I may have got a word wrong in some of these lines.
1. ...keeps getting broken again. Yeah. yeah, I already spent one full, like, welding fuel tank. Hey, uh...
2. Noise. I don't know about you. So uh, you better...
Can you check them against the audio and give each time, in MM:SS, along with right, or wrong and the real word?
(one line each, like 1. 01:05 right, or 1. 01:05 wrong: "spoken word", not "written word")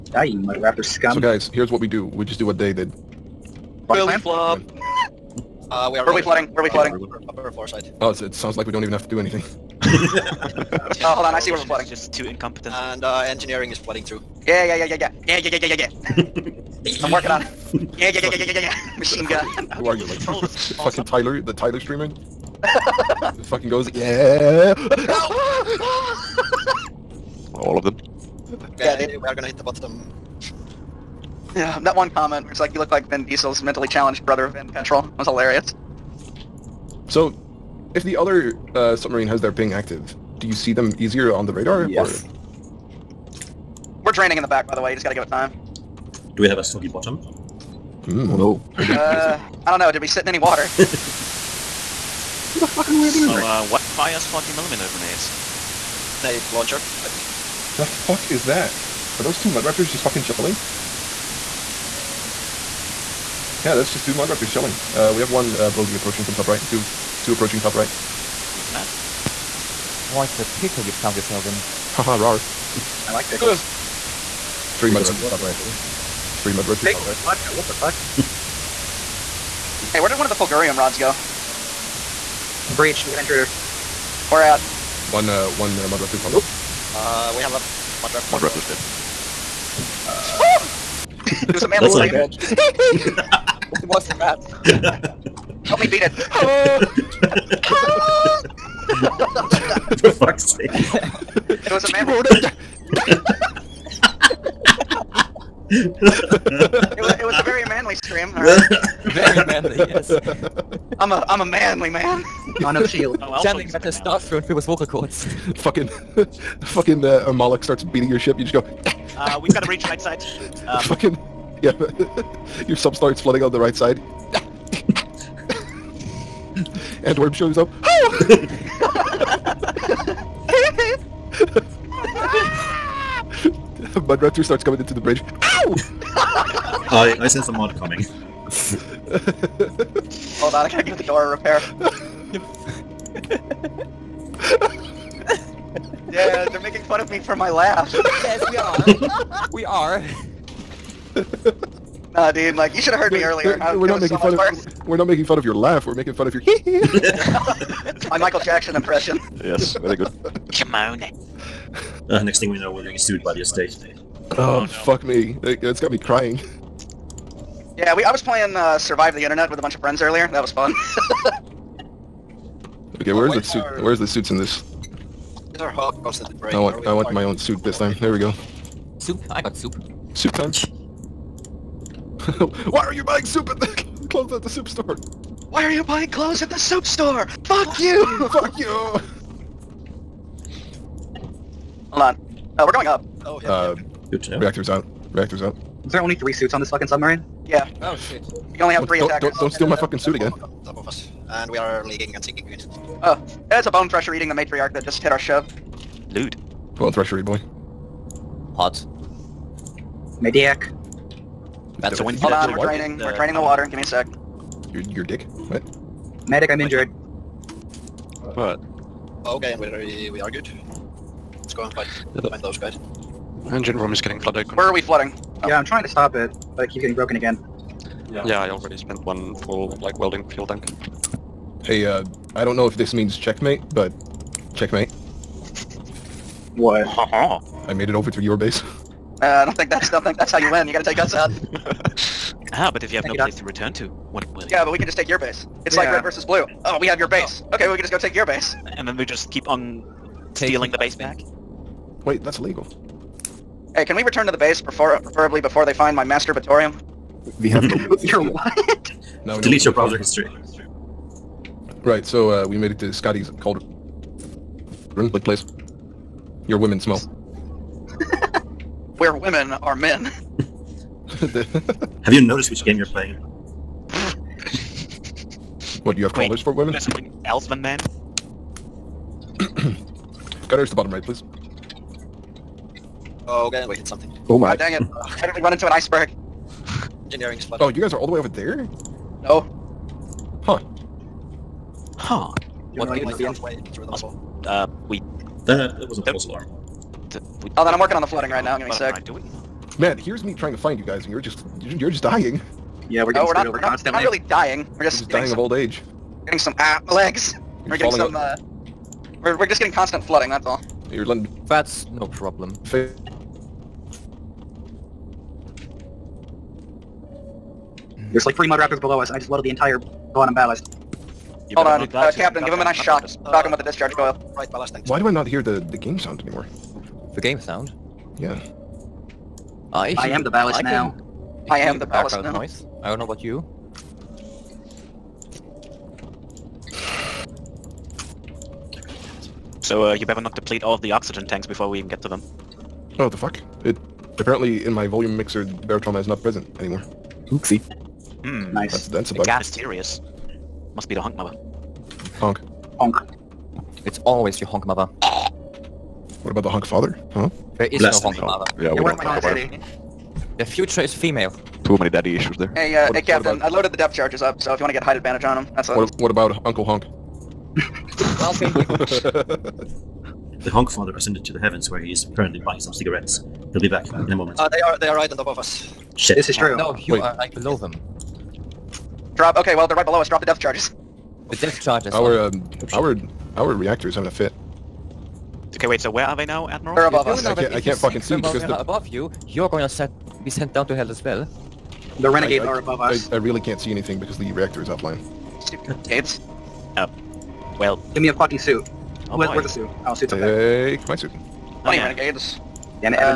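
1. 03:46 right
2. 05:32 right.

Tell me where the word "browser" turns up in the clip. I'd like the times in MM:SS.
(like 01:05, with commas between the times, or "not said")
04:19.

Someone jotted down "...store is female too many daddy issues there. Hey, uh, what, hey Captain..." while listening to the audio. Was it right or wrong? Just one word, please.
wrong.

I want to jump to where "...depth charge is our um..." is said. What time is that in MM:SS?
06:21.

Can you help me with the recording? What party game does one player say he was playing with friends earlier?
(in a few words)
Survive the Internet.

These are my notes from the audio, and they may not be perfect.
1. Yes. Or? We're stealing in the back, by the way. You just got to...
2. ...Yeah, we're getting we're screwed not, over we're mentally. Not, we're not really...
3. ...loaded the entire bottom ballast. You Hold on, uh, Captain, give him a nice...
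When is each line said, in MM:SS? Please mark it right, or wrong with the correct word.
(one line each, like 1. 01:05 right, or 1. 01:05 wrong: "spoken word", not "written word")
1. 00:41 wrong: "draining", not "stealing"
2. 05:02 wrong: "constantly", not "mentally"
3. 05:19 right.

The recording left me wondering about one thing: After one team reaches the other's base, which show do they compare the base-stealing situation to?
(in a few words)
Red versus Blue.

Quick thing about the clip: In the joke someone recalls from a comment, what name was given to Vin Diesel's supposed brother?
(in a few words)
Vin Petrol.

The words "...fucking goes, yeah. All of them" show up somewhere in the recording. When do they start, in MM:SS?
00:23.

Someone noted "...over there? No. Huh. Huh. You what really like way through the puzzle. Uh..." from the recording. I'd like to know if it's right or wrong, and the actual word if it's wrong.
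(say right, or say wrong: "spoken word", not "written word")
right.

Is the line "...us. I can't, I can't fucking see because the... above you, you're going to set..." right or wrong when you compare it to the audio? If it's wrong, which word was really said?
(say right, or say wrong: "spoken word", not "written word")
right.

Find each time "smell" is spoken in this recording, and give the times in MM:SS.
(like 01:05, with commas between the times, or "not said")
04:26.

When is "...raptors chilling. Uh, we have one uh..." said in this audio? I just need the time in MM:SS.
01:04.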